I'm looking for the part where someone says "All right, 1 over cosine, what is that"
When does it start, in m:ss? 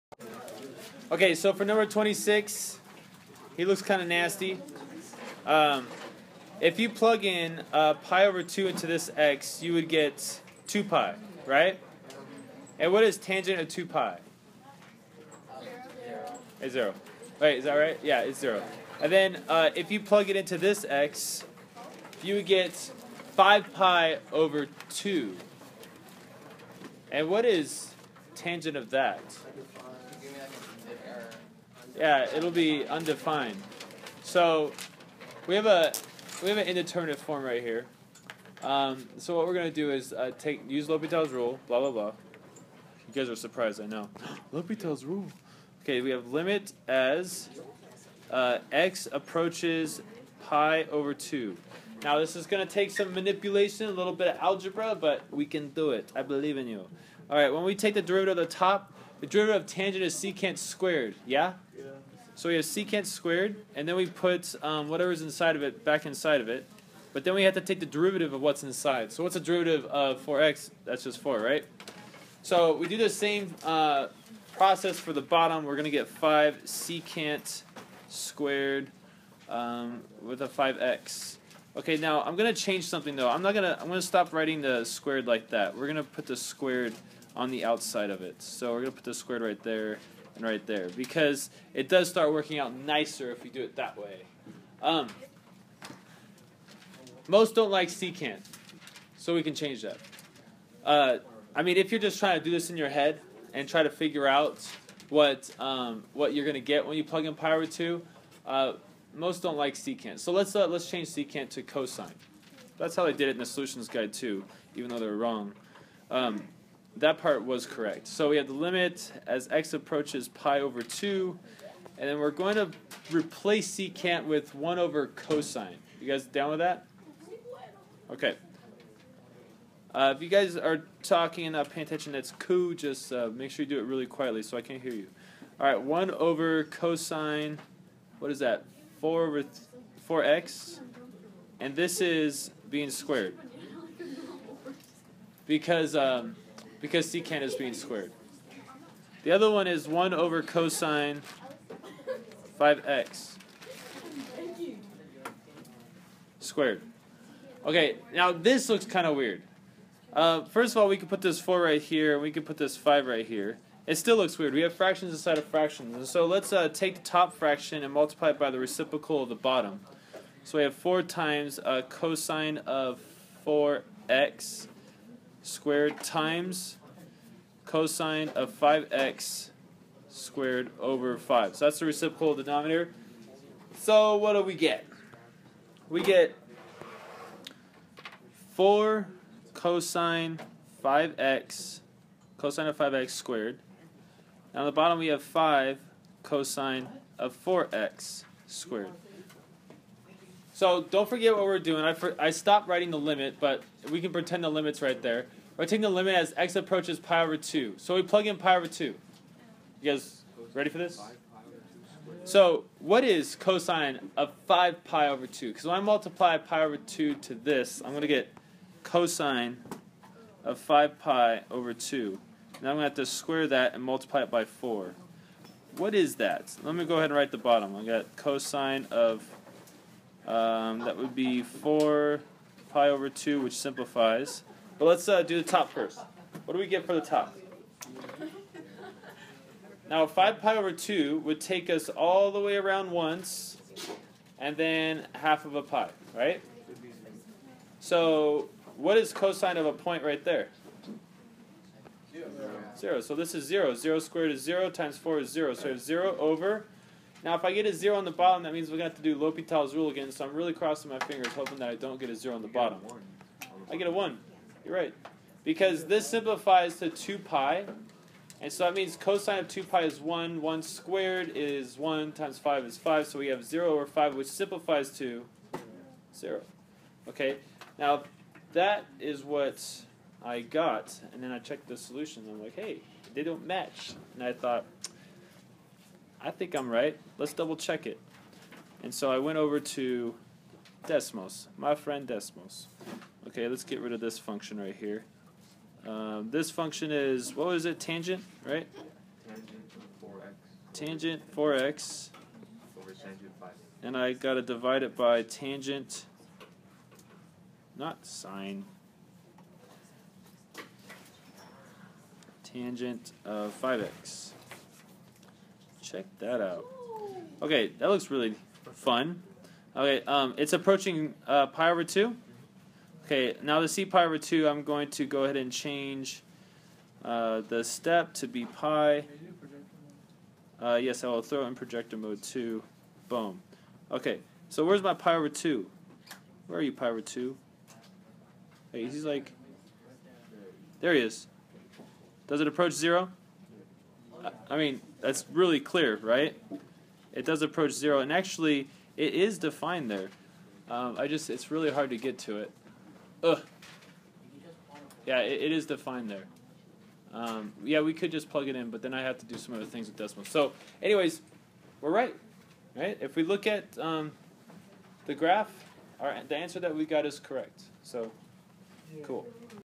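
2:15.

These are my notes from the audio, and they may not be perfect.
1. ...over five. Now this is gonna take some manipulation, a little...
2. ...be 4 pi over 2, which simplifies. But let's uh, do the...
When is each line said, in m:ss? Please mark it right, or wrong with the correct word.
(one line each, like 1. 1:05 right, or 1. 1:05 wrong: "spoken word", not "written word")
1. 0:50 wrong: "two", not "five"
2. 3:51 right.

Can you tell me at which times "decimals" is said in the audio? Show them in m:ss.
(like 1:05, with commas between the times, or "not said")
5:59.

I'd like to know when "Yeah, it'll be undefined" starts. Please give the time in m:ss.
0:31.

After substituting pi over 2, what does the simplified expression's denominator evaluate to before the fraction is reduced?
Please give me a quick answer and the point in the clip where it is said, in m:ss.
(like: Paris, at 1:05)
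5, at 4:32.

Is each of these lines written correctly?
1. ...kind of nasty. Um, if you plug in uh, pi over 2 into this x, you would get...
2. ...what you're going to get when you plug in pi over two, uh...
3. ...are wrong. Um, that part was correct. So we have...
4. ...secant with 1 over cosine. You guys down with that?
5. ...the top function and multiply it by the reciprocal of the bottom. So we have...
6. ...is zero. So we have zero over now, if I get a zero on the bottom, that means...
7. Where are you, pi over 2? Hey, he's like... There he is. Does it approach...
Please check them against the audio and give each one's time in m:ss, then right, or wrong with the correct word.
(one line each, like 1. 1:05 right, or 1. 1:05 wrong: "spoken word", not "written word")
1. 0:03 right
2. 1:46 right
3. 1:55 right
4. 2:03 right
5. 2:46 wrong: "fraction", not "function"
6. 4:15 right
7. 5:36 right.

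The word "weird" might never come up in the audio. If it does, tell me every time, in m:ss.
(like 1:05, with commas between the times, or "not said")
2:39, 2:44.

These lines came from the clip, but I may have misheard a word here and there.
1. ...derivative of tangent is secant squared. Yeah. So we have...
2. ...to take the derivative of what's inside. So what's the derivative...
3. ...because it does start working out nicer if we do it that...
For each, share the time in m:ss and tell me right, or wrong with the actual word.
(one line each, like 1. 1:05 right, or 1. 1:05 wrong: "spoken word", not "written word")
1. 0:59 right
2. 1:07 right
3. 1:30 right.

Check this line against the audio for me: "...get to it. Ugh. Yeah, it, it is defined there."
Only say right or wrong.
right.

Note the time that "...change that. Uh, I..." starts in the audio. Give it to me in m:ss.
1:39.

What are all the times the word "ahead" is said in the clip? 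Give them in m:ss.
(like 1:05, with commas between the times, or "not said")
3:46, 5:25.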